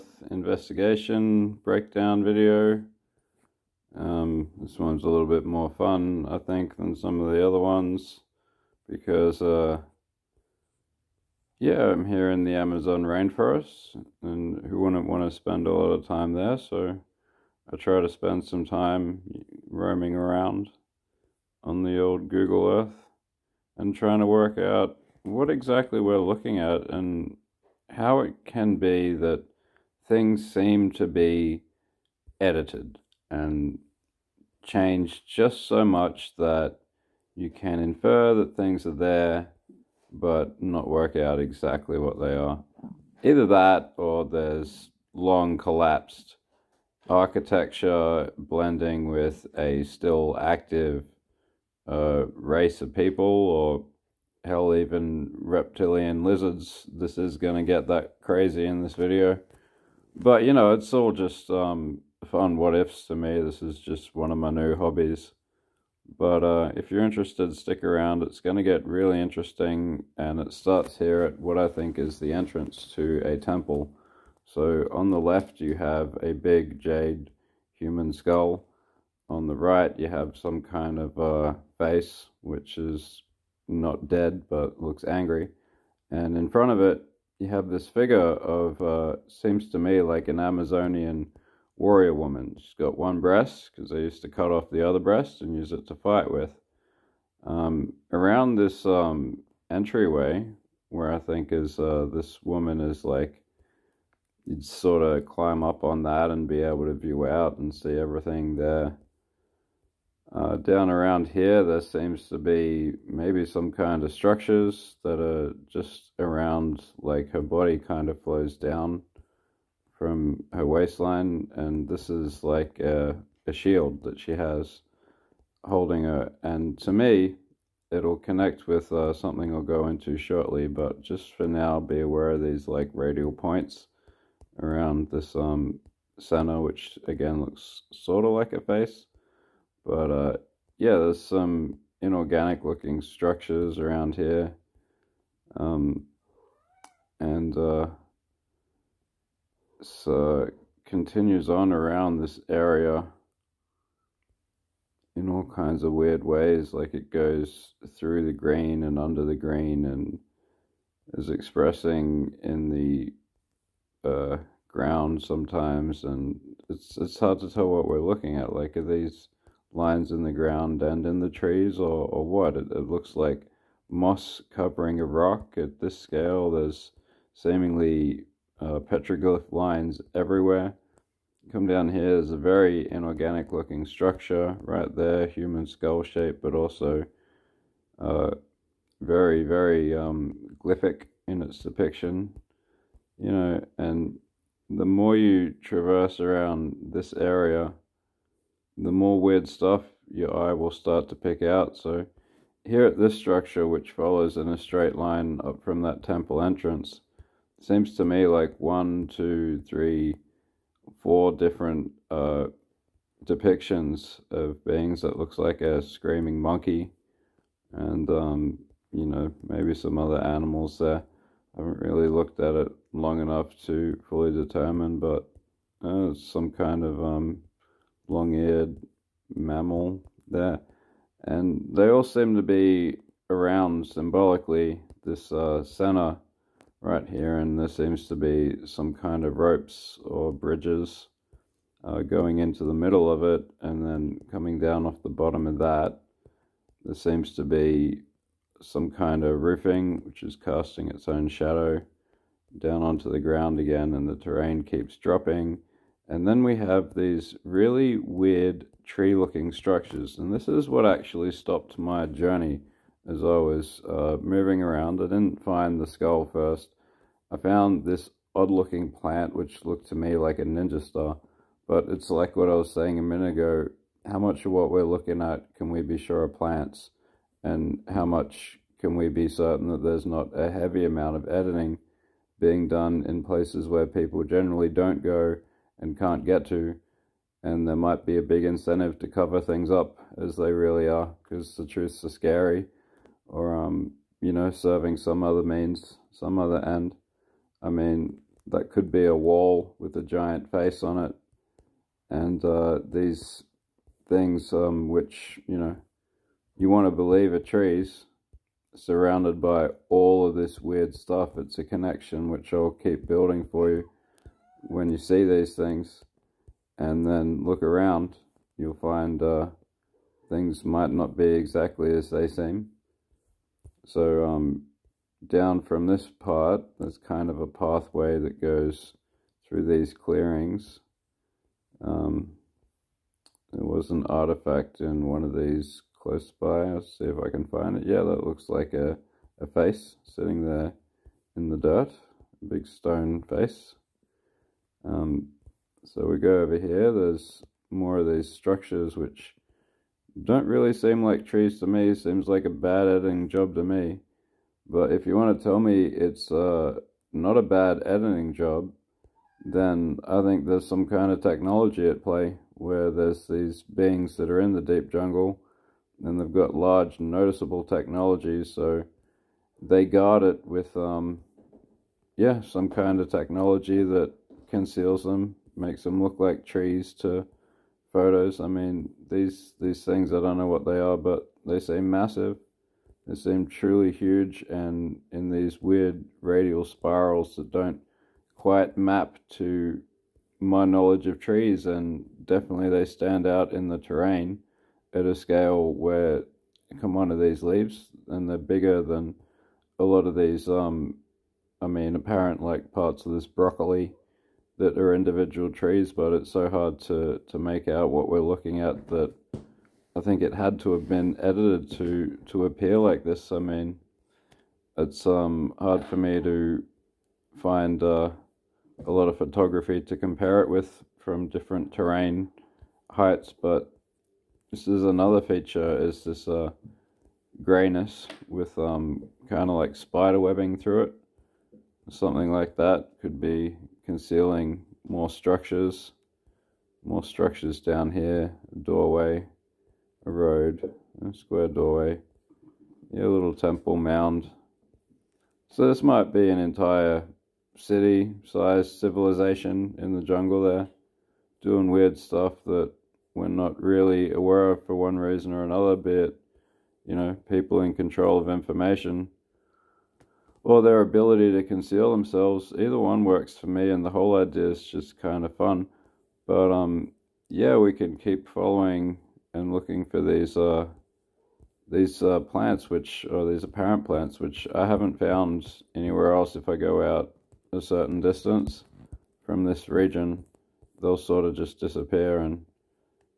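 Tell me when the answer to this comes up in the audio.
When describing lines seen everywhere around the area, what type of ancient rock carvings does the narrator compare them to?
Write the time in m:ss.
2:58.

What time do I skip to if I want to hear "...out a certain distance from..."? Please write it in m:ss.
7:56.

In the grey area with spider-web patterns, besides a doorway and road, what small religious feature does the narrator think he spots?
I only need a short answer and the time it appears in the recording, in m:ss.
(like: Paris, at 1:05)
A little temple mound, at 7:23.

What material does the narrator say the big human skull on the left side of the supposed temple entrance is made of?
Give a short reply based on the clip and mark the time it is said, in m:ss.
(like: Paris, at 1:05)
Jade, at 1:16.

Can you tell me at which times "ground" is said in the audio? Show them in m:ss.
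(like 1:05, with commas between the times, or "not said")
2:44, 2:50, 4:13.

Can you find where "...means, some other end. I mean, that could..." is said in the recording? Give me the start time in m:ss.
4:55.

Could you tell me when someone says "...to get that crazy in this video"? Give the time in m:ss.
0:57.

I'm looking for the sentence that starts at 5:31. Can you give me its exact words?
Um, there was an artifact in one of these close by.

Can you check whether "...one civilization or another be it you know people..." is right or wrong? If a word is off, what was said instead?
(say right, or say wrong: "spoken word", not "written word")
wrong: "reason", not "civilization".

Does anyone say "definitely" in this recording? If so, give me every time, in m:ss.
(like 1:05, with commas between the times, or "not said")
6:32.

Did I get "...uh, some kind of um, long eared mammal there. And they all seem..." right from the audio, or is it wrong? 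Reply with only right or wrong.
right.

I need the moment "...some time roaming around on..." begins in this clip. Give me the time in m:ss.
0:18.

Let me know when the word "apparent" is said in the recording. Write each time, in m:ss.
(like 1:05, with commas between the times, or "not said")
6:41, 7:53.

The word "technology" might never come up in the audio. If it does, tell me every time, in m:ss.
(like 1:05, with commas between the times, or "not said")
6:01, 6:07, 6:13.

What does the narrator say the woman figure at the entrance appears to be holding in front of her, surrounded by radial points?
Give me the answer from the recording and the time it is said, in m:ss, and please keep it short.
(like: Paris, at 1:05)
A shield, at 2:03.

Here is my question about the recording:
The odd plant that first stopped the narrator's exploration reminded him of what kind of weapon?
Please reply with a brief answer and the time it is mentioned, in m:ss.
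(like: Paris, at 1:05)
A ninja star, at 4:30.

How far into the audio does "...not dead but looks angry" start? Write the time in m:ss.
1:23.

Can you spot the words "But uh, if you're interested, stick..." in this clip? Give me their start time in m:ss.
1:06.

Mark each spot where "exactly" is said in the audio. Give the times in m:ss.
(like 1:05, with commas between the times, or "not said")
0:25, 0:41, 5:21.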